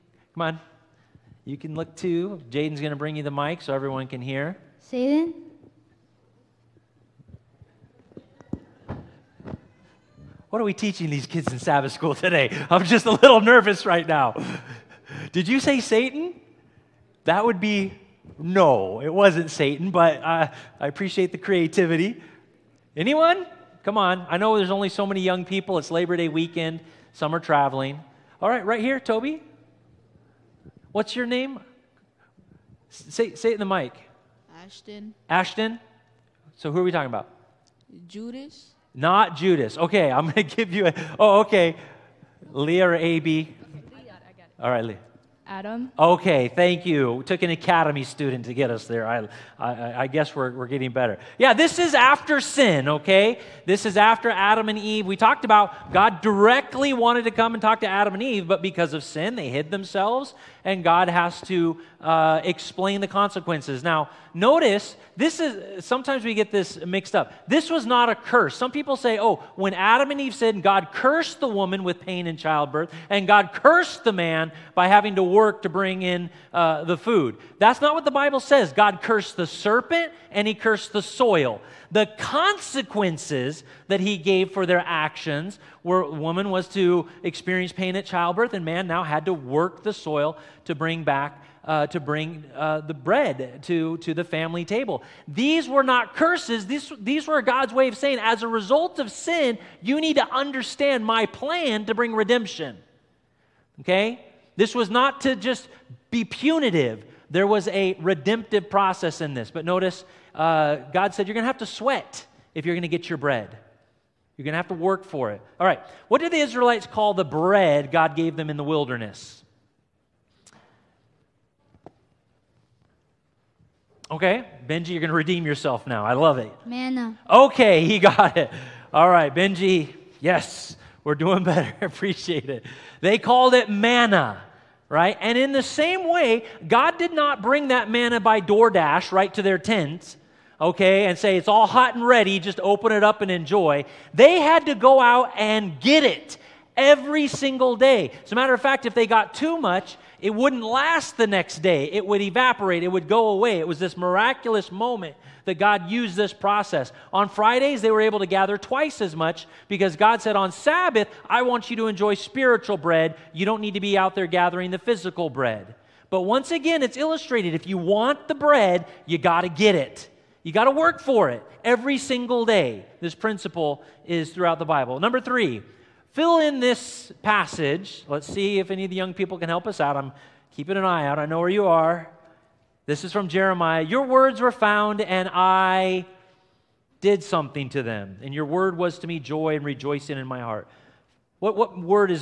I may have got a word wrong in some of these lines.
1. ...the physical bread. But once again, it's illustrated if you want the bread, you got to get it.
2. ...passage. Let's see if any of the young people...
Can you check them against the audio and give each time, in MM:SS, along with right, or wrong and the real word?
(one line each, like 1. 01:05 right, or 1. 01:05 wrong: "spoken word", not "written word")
1. 02:44 right
2. 02:57 right.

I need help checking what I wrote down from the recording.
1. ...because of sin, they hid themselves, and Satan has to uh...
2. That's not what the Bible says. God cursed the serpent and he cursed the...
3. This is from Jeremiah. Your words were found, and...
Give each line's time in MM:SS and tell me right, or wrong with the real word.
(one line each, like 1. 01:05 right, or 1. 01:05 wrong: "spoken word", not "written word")
1. 00:58 wrong: "God", not "Satan"
2. 01:17 right
3. 03:02 right.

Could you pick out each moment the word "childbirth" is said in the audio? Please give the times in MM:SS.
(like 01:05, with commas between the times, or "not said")
01:12, 01:28.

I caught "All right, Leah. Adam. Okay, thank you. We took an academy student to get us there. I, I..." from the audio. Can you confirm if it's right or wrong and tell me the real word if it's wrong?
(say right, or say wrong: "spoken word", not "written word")
right.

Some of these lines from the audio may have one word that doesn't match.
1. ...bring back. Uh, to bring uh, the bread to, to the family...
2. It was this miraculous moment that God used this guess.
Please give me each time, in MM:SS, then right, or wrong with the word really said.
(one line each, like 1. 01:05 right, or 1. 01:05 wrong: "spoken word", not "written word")
1. 01:30 right
2. 02:33 wrong: "process", not "guess".